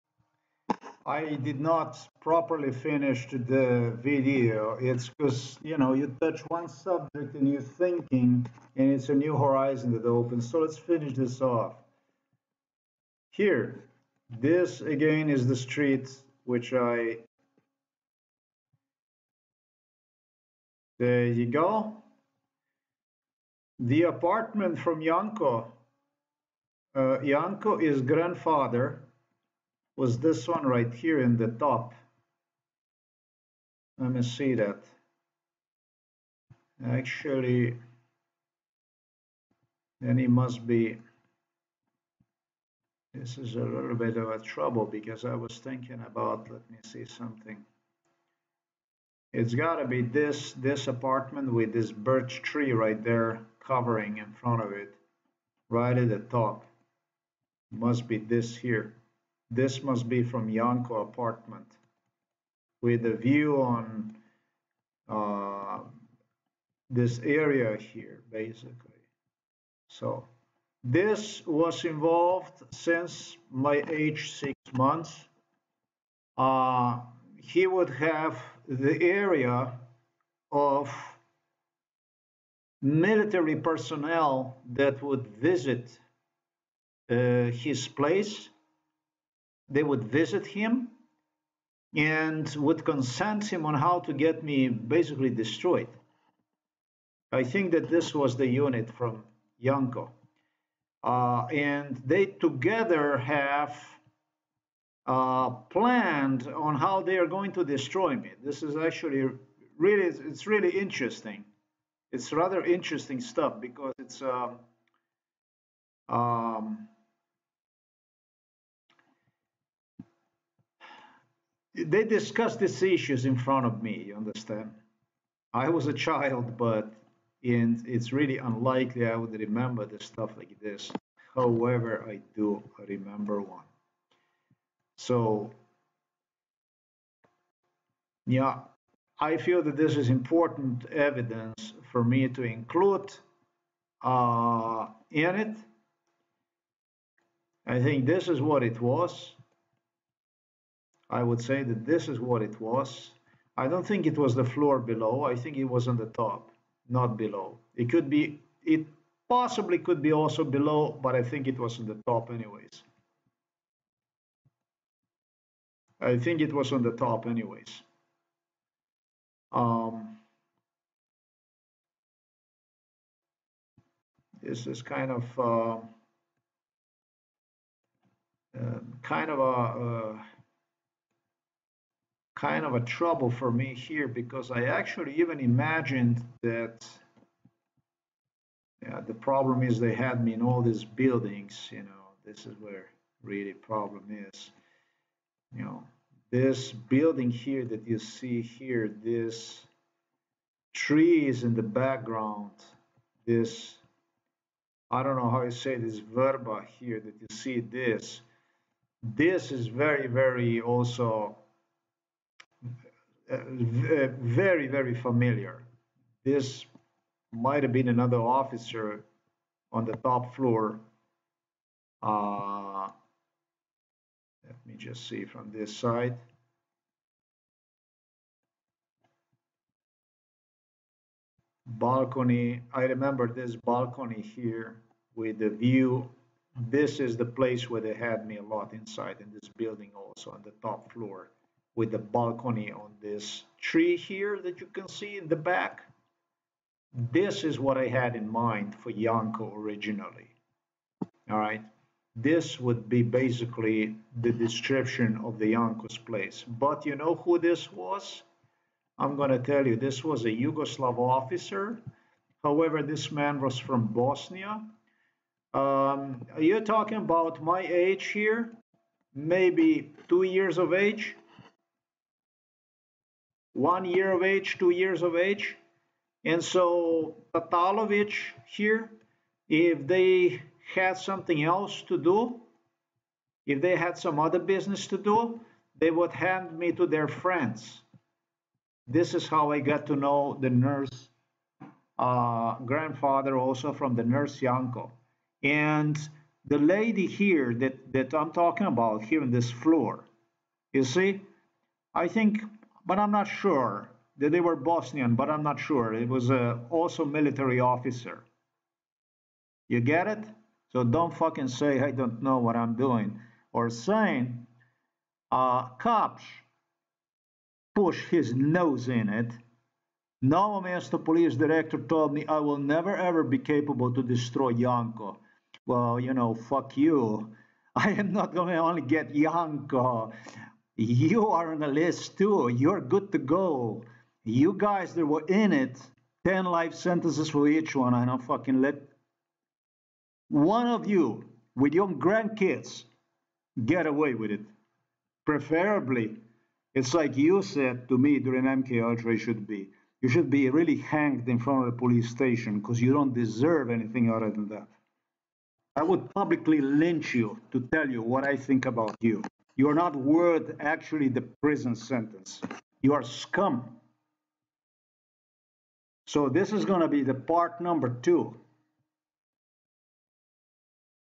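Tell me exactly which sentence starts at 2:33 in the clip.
I don't think it was the floor below.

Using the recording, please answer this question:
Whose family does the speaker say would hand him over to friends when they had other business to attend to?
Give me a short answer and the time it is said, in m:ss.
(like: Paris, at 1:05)
Tatalovich, at 4:37.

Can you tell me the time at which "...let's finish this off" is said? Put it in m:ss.
0:10.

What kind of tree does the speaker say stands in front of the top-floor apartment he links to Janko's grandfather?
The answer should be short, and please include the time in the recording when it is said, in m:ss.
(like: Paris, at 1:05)
birch tree, at 0:51.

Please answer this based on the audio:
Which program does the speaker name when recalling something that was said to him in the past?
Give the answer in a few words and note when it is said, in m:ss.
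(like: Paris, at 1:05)
MK Ultra, at 5:48.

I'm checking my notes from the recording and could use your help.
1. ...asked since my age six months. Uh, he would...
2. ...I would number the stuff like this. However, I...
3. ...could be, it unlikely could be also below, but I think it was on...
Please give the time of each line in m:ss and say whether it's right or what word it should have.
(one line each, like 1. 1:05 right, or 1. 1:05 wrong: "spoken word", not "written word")
1. 1:11 wrong: "involved", not "asked"
2. 2:09 wrong: "remember", not "number"
3. 2:37 wrong: "possibly", not "unlikely".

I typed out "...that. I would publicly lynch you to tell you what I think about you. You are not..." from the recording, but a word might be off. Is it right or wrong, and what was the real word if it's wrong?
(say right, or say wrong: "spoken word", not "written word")
right.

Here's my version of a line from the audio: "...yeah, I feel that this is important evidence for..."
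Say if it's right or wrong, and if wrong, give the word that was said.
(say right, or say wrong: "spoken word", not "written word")
right.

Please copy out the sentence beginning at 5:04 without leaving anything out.
that They were Bosnian, but I'm not sure.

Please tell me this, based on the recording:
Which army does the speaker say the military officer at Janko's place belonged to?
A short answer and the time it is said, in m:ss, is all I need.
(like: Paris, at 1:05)
Yugoslav, at 4:20.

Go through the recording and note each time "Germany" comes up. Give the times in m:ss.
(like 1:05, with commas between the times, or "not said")
not said.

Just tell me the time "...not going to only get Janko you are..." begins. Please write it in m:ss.
5:28.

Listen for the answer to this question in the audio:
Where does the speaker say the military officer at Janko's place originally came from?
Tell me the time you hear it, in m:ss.
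4:23.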